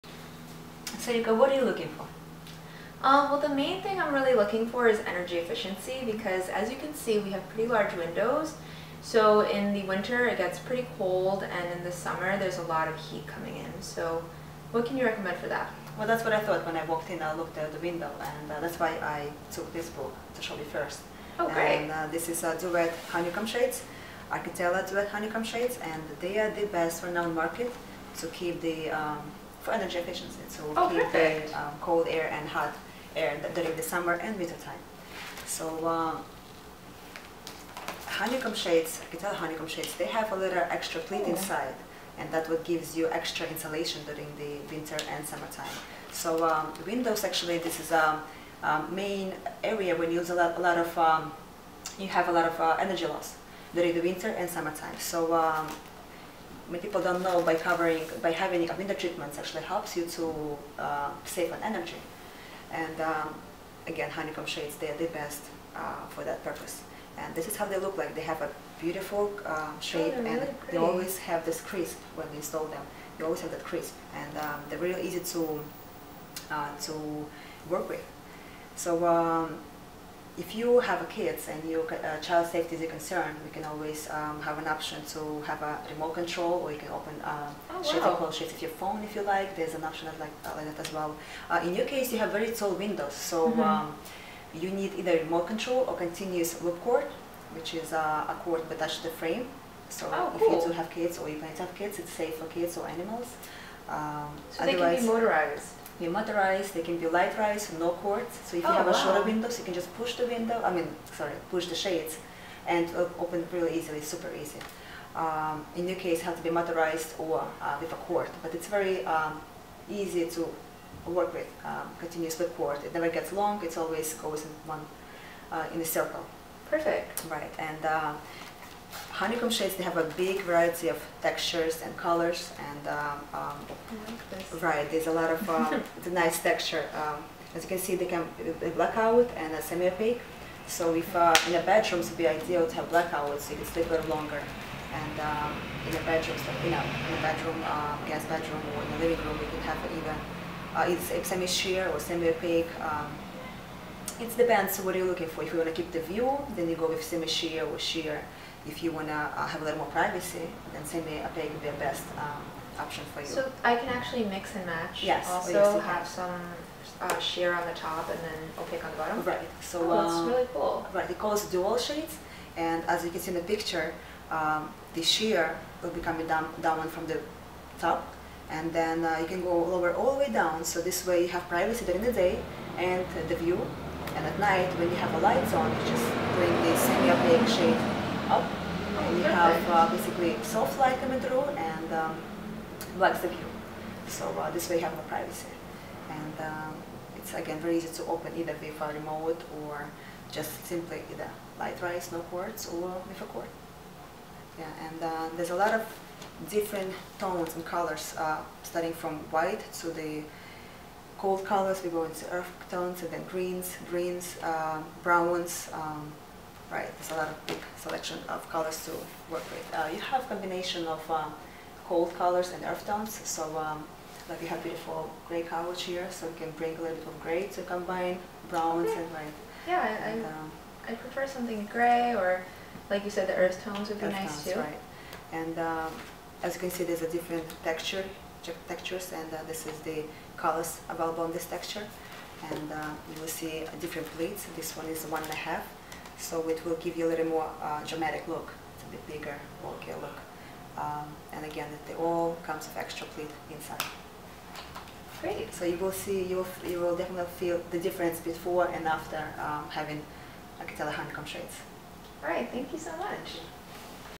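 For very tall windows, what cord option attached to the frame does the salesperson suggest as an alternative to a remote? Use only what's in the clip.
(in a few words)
continuous loop cord.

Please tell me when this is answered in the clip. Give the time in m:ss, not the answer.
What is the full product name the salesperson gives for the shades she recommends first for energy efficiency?
0:24.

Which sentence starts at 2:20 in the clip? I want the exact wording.
So if uh, in the bedrooms, it'd be ideal to have blackouts.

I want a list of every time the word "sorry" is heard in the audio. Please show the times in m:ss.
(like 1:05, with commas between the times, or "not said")
1:51.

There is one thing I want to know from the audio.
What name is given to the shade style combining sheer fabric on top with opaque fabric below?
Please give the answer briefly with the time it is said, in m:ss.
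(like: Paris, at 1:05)
dual shades, at 2:51.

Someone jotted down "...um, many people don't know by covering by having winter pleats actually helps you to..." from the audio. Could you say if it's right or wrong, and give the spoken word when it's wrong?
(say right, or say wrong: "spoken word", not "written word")
wrong: "treatments", not "pleats".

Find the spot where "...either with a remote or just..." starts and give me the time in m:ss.
3:18.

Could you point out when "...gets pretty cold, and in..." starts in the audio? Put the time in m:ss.
0:10.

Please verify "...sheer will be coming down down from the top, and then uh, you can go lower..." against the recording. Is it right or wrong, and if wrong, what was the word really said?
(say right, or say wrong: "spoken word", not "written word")
right.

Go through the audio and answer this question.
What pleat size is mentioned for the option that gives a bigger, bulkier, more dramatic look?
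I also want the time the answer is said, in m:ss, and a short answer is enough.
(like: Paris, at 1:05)
1.5, at 4:05.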